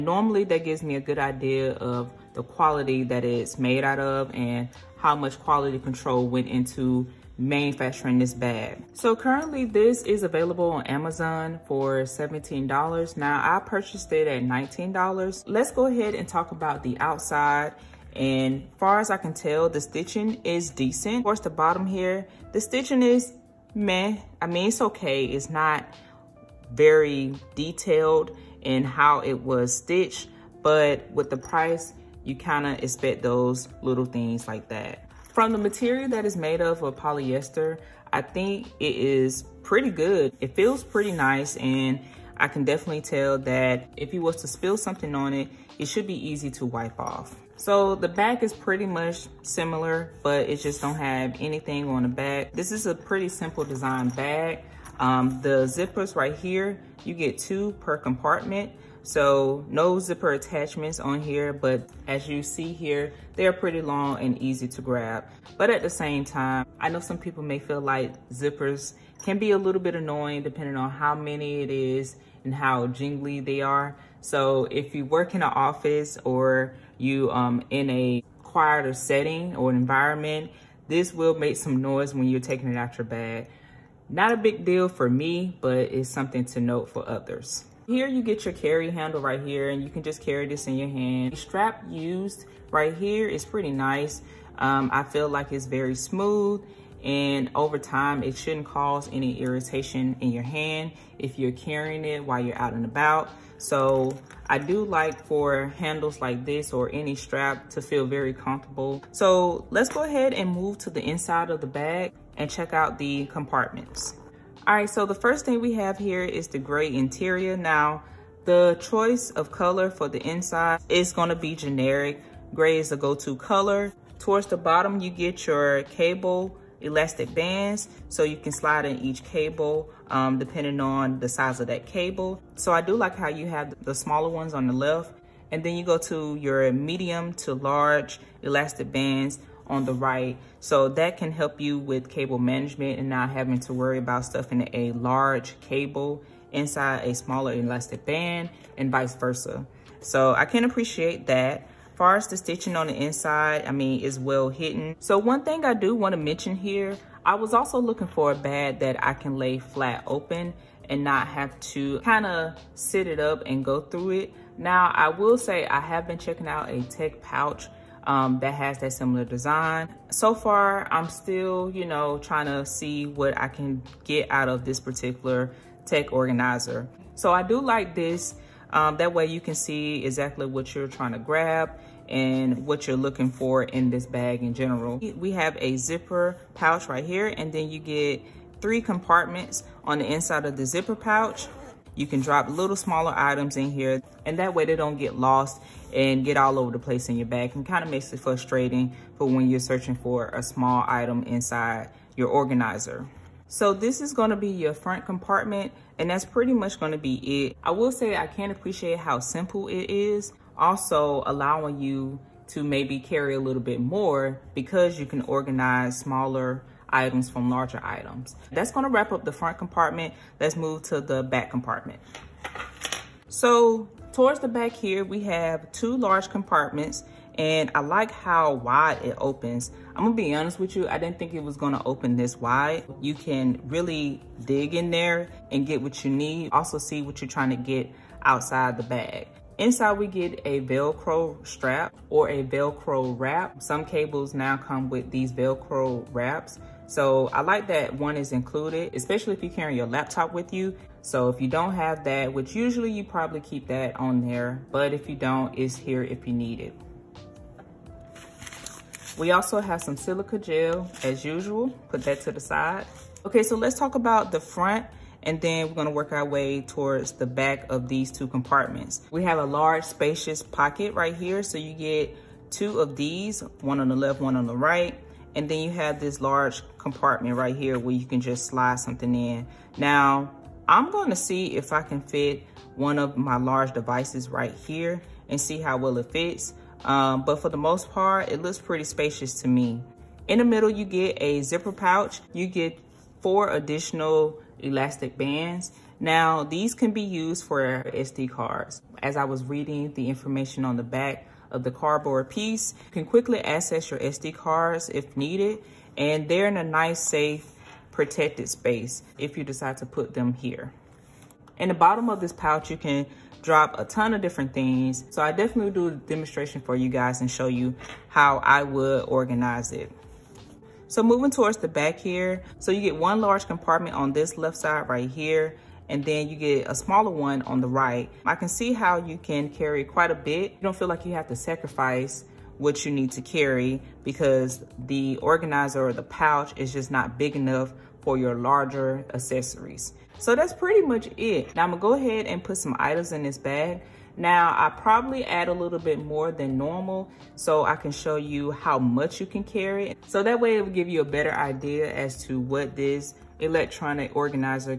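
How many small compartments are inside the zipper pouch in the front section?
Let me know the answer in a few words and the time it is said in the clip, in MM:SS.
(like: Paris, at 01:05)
3, at 03:08.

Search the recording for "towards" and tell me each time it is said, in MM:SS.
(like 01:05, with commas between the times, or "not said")
02:04, 03:44, 04:26, 05:21.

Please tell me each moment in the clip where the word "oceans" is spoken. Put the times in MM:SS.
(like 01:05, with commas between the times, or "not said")
not said.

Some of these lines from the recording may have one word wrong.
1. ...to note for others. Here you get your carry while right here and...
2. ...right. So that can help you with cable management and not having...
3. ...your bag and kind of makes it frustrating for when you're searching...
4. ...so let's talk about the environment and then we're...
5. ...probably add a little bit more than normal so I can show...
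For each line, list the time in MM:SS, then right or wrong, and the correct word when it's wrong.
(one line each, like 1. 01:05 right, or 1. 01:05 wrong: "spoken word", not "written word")
1. 01:26 wrong: "handle", not "while"
2. 02:19 right
3. 03:17 right
4. 04:23 wrong: "front", not "environment"
5. 05:44 right.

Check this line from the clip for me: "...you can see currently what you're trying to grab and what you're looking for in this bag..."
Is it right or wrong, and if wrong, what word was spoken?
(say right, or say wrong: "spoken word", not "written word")
wrong: "exactly", not "currently".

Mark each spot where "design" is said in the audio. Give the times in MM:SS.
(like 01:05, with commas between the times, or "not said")
00:53, 02:49.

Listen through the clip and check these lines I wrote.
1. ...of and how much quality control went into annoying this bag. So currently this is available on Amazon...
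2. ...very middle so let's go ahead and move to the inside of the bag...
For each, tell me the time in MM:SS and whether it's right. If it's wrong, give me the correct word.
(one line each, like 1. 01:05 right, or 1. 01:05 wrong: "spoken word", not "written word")
1. 00:03 wrong: "manufacturing", not "annoying"
2. 01:48 wrong: "comfortable", not "middle".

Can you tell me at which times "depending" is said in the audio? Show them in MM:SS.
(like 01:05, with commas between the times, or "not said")
01:10, 02:10.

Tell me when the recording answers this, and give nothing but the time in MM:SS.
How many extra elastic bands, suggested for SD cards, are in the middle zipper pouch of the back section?
04:53.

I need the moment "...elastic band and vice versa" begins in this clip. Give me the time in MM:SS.
02:27.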